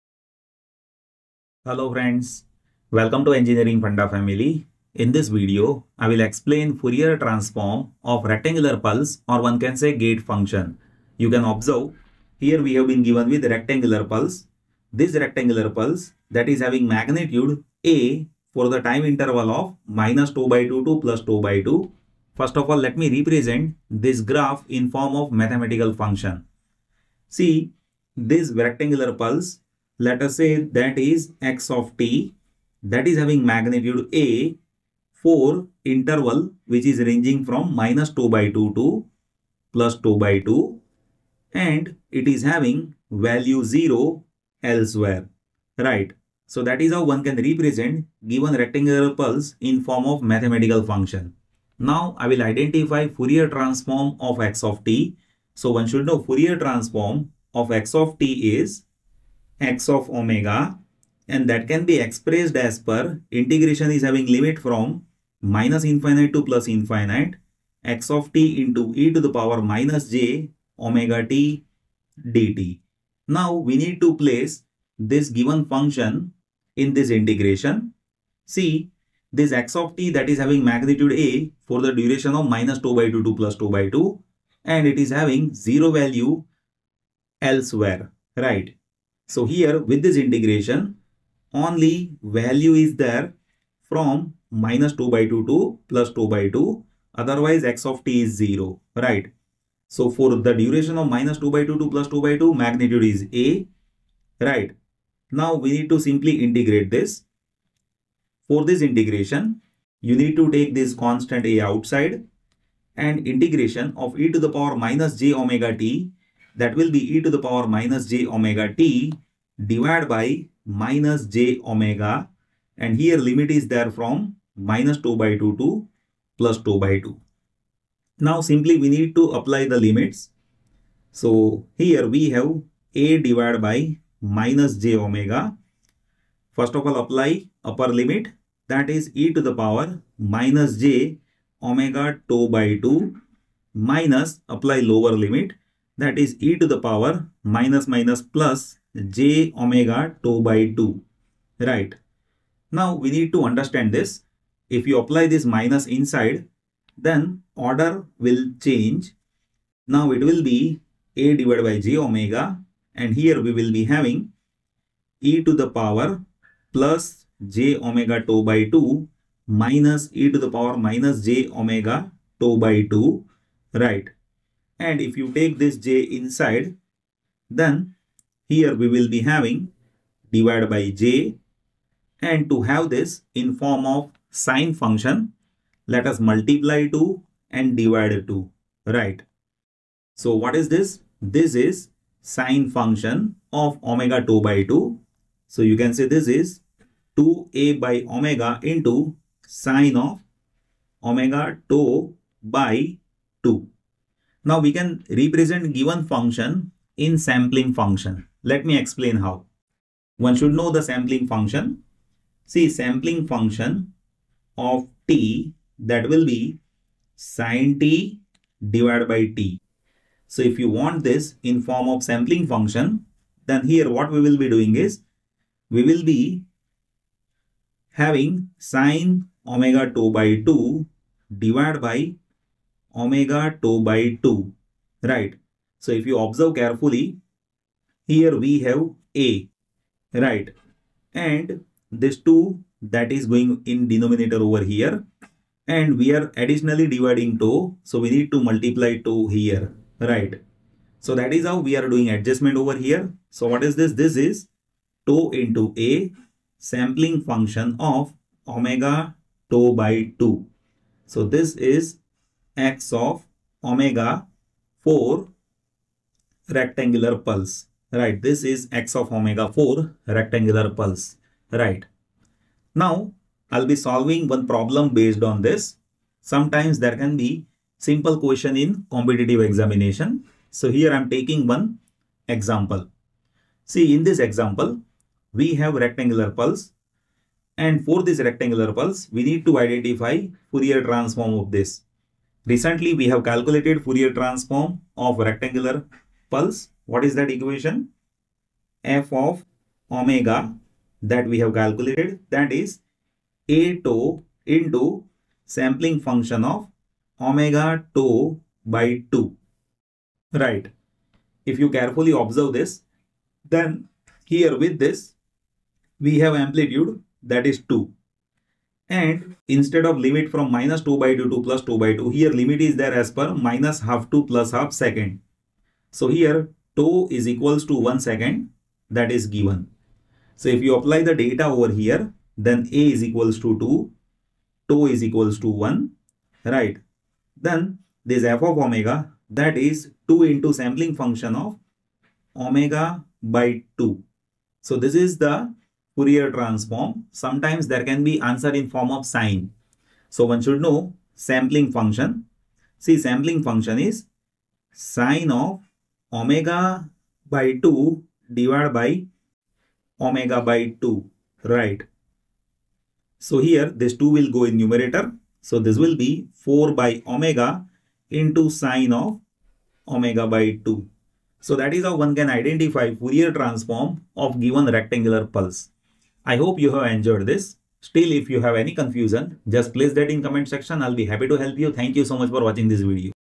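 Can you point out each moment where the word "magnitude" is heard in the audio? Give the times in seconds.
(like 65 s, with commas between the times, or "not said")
16 s, 33 s, 80 s, 102 s.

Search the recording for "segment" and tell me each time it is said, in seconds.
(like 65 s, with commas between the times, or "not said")
not said.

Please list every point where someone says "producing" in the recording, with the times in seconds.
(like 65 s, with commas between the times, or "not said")
not said.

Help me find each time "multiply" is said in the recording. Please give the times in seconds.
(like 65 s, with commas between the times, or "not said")
186 s, 248 s.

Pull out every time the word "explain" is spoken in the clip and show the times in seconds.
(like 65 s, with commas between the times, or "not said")
6 s, 208 s.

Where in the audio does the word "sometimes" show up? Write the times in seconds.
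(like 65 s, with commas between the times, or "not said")
276 s, 347 s.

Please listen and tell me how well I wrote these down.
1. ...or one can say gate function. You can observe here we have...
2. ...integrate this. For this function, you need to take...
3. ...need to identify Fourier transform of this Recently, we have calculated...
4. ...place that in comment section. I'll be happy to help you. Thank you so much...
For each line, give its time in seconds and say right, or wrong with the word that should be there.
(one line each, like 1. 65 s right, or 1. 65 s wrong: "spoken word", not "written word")
1. 9 s right
2. 106 s wrong: "integration", not "function"
3. 289 s right
4. 379 s right.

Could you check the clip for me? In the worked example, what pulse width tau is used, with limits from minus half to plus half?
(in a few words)
1 second.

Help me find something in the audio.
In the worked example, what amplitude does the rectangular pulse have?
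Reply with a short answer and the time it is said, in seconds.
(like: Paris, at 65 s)
2, at 316 s.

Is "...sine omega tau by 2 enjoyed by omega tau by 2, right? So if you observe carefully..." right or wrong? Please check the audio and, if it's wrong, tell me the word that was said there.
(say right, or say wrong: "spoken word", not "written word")
wrong: "divided", not "enjoyed".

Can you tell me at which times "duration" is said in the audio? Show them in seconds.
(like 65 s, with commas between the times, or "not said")
81 s, 100 s.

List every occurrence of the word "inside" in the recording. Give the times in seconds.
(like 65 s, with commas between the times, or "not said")
155 s, 176 s.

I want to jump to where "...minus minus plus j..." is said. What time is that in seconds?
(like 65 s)
147 s.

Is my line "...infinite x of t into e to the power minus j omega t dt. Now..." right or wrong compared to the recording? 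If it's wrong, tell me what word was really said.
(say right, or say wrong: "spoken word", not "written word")
right.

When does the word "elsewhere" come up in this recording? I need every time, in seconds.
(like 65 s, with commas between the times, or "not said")
44 s, 87 s.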